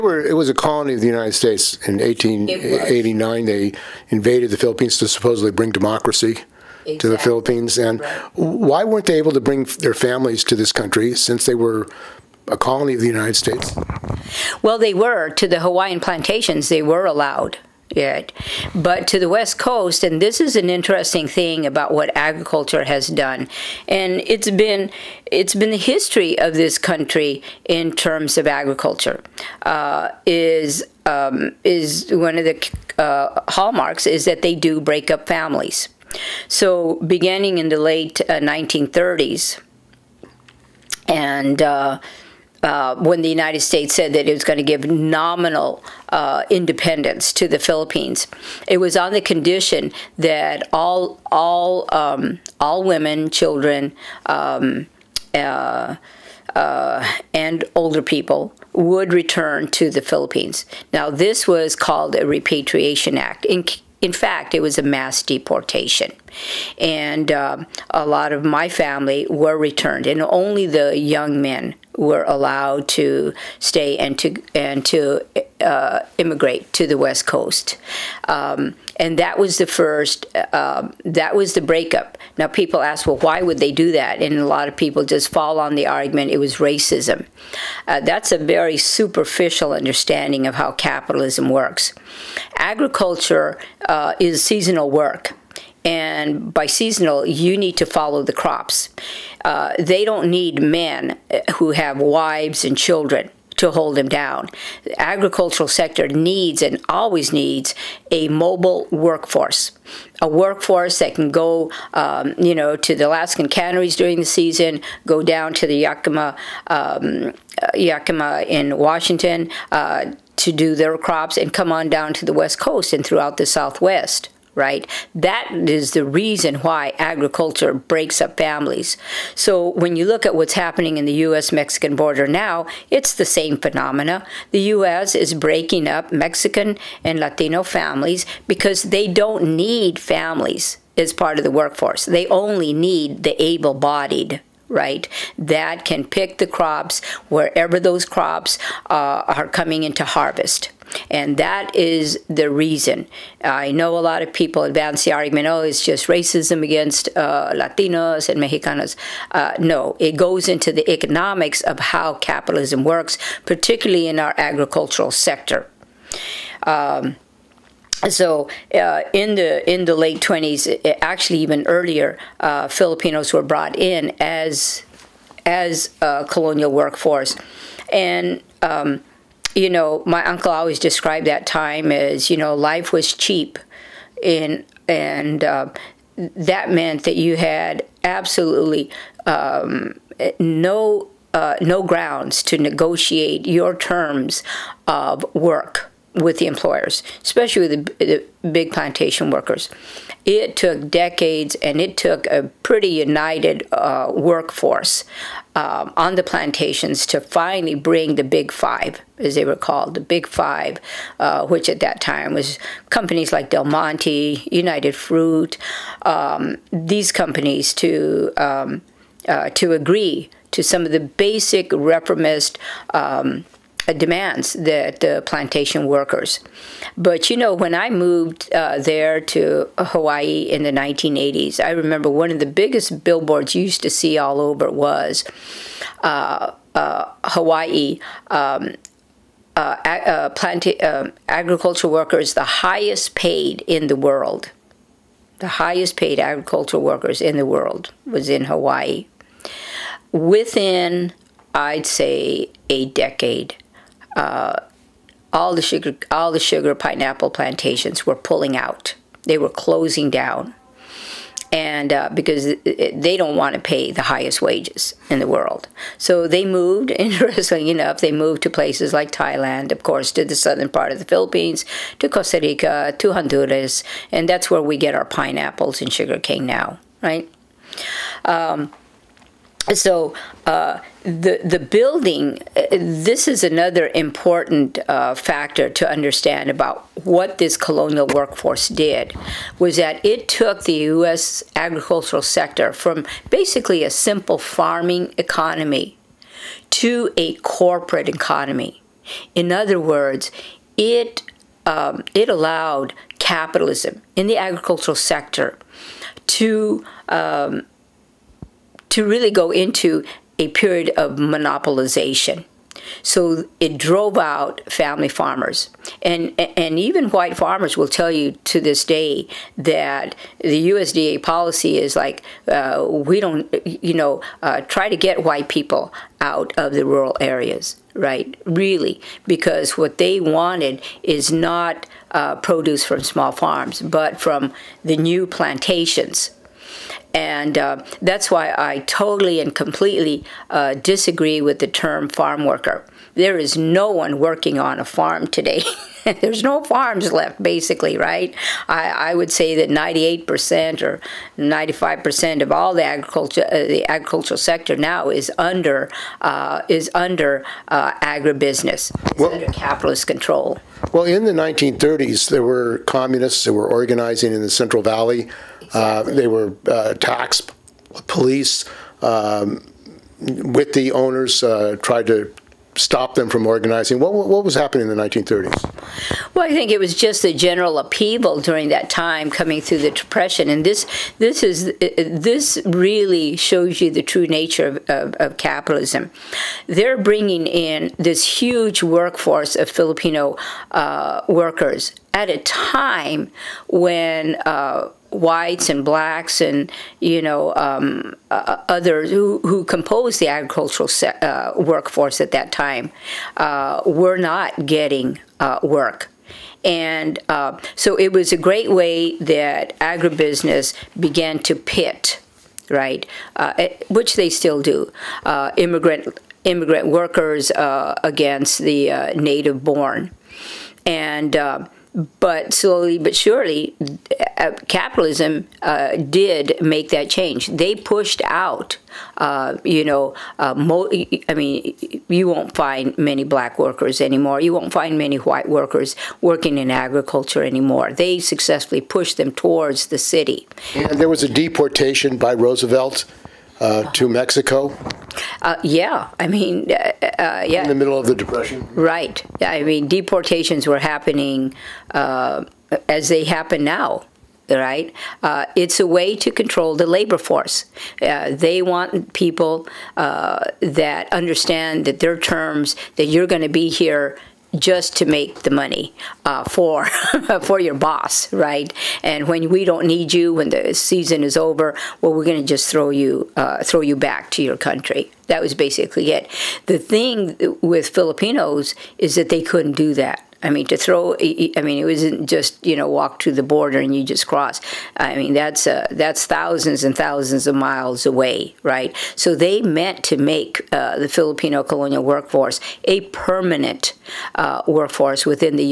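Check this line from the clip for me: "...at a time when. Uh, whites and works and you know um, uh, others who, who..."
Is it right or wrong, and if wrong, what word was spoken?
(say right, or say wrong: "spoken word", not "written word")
wrong: "blacks", not "works".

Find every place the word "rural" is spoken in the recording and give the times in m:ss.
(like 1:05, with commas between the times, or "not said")
5:26.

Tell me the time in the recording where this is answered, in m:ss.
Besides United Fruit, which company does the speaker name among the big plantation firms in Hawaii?
3:33.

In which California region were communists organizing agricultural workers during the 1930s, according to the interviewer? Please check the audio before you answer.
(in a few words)
Central Valley.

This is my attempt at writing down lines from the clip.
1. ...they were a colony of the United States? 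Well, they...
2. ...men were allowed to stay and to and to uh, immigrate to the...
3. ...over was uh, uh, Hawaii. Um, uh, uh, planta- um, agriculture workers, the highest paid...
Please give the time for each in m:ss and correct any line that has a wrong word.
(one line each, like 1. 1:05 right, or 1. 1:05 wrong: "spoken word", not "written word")
1. 0:11 right
2. 1:11 right
3. 3:54 right.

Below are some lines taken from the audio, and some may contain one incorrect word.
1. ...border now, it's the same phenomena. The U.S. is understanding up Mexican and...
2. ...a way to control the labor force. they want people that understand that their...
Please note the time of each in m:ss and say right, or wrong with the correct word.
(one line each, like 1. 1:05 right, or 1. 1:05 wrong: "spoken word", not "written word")
1. 2:11 wrong: "breaking", not "understanding"
2. 7:35 right.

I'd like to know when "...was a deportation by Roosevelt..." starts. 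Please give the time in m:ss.
7:21.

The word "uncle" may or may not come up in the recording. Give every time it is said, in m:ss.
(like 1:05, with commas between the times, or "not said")
3:00.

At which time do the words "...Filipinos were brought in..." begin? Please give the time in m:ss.
2:52.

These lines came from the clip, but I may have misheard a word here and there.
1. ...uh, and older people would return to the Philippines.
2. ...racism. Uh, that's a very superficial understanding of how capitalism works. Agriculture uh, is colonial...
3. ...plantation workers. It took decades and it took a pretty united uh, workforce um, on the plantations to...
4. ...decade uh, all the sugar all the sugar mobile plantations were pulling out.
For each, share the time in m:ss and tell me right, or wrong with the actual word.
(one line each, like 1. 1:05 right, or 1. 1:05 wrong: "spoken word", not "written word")
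1. 0:56 right
2. 1:26 wrong: "seasonal", not "colonial"
3. 3:18 right
4. 4:12 wrong: "pineapple", not "mobile".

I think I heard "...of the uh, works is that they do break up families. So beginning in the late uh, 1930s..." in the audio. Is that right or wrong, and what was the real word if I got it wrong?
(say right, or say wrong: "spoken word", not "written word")
wrong: "hallmarks", not "works".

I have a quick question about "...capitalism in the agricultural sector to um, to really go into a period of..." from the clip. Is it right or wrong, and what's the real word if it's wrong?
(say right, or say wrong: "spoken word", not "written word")
right.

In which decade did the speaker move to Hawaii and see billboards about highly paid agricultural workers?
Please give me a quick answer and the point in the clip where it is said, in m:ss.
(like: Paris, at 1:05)
1980s, at 3:50.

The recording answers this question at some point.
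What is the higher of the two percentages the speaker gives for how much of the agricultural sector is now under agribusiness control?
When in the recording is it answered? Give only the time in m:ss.
5:49.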